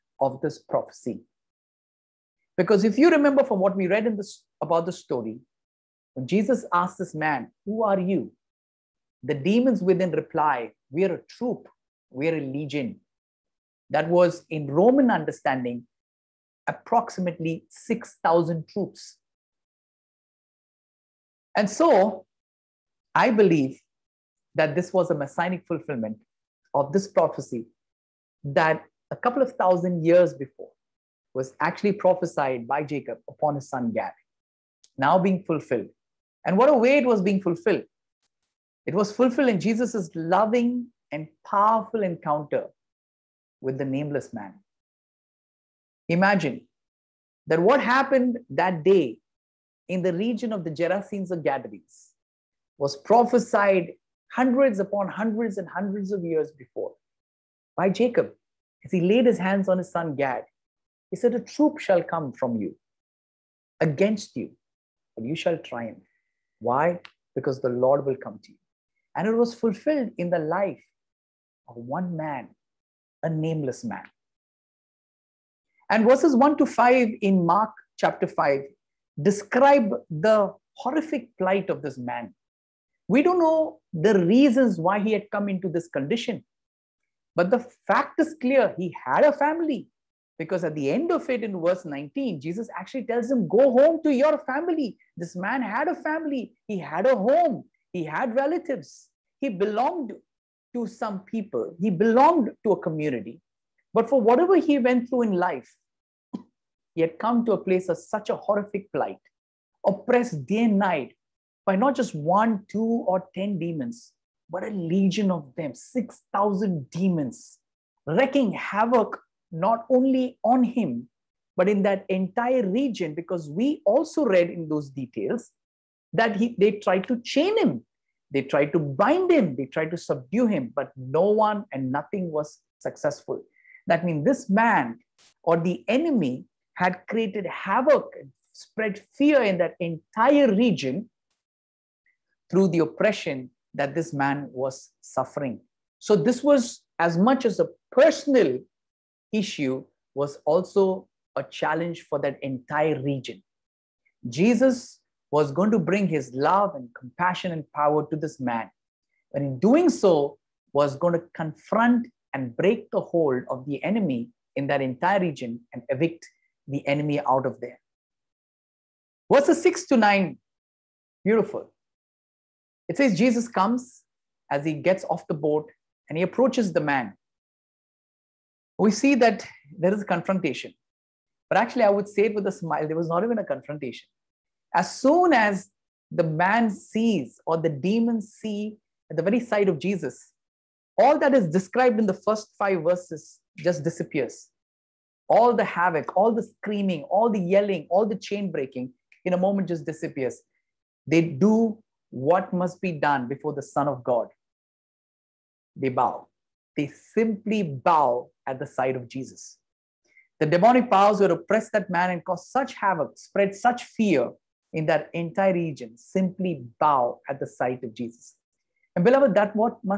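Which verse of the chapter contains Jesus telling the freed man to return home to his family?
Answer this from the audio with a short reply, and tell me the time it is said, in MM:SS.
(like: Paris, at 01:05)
Verse 19, at 01:31.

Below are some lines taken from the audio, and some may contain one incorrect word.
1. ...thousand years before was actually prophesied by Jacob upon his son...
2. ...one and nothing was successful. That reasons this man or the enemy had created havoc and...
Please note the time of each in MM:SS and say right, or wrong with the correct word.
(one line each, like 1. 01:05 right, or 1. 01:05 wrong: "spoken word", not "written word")
1. 00:29 right
2. 02:11 wrong: "means", not "reasons".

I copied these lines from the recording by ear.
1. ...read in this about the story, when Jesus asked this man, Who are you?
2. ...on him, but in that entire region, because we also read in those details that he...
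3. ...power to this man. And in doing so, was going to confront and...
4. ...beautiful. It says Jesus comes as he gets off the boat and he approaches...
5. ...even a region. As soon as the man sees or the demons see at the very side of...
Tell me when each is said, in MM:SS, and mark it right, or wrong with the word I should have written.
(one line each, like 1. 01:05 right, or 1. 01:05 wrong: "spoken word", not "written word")
1. 00:03 right
2. 02:00 right
3. 02:37 right
4. 02:51 right
5. 03:03 wrong: "confrontation", not "region".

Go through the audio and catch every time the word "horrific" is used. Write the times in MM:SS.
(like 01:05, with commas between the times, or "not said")
01:20, 01:48.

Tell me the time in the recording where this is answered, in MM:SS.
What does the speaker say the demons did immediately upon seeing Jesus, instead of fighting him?
03:25.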